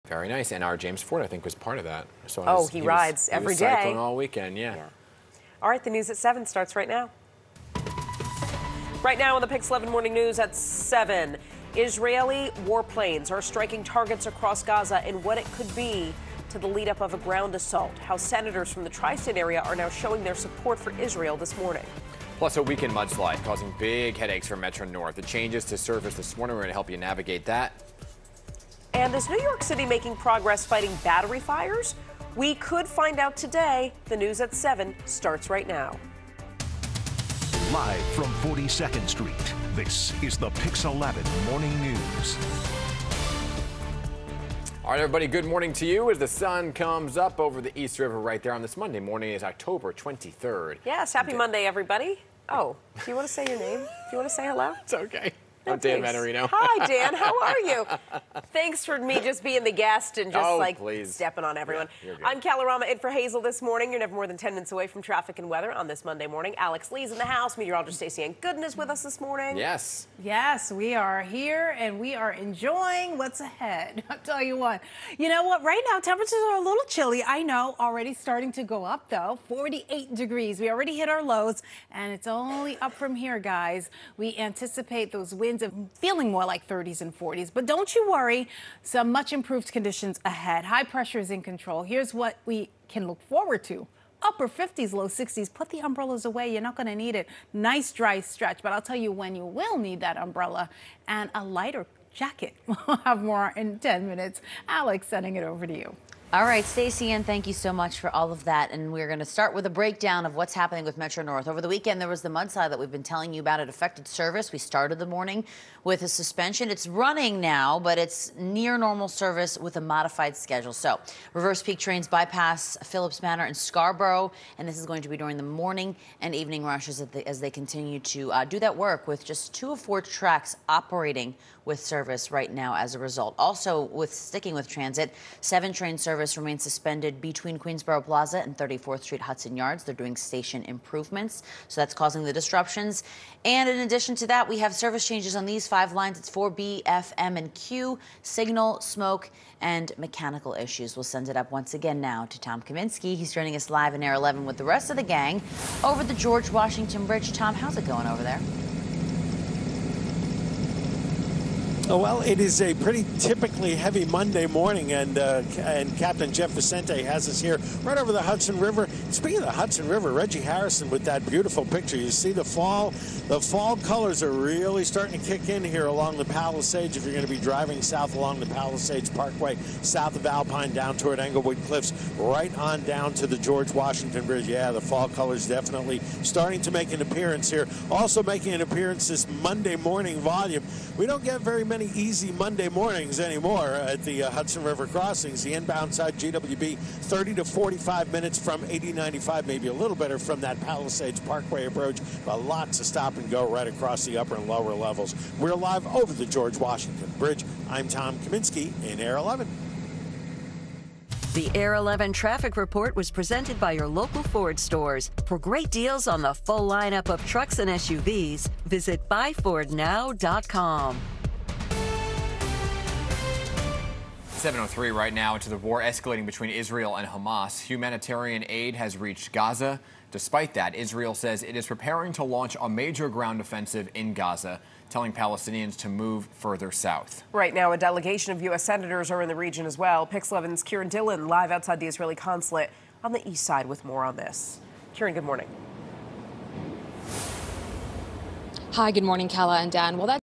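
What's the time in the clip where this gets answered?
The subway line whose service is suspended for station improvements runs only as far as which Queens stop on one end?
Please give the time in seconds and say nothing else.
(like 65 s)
137 s.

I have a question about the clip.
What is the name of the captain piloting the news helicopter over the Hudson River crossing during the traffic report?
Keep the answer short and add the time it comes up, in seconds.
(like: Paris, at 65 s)
Jeff Vicente, at 166 s.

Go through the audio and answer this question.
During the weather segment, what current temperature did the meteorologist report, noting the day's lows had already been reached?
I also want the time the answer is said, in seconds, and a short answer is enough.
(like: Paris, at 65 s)
48 degrees, at 79 s.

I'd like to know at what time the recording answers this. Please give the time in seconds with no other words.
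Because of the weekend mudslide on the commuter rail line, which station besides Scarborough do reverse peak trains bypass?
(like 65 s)
122 s.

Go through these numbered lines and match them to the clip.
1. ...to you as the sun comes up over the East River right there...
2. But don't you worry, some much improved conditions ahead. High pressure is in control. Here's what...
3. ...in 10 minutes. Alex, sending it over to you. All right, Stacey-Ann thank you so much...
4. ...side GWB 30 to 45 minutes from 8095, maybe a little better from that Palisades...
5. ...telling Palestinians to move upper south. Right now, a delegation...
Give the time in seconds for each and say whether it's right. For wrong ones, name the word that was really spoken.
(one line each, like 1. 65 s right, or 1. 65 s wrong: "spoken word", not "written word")
1. 45 s right
2. 87 s right
3. 103 s right
4. 195 s right
5. 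234 s wrong: "further", not "upper".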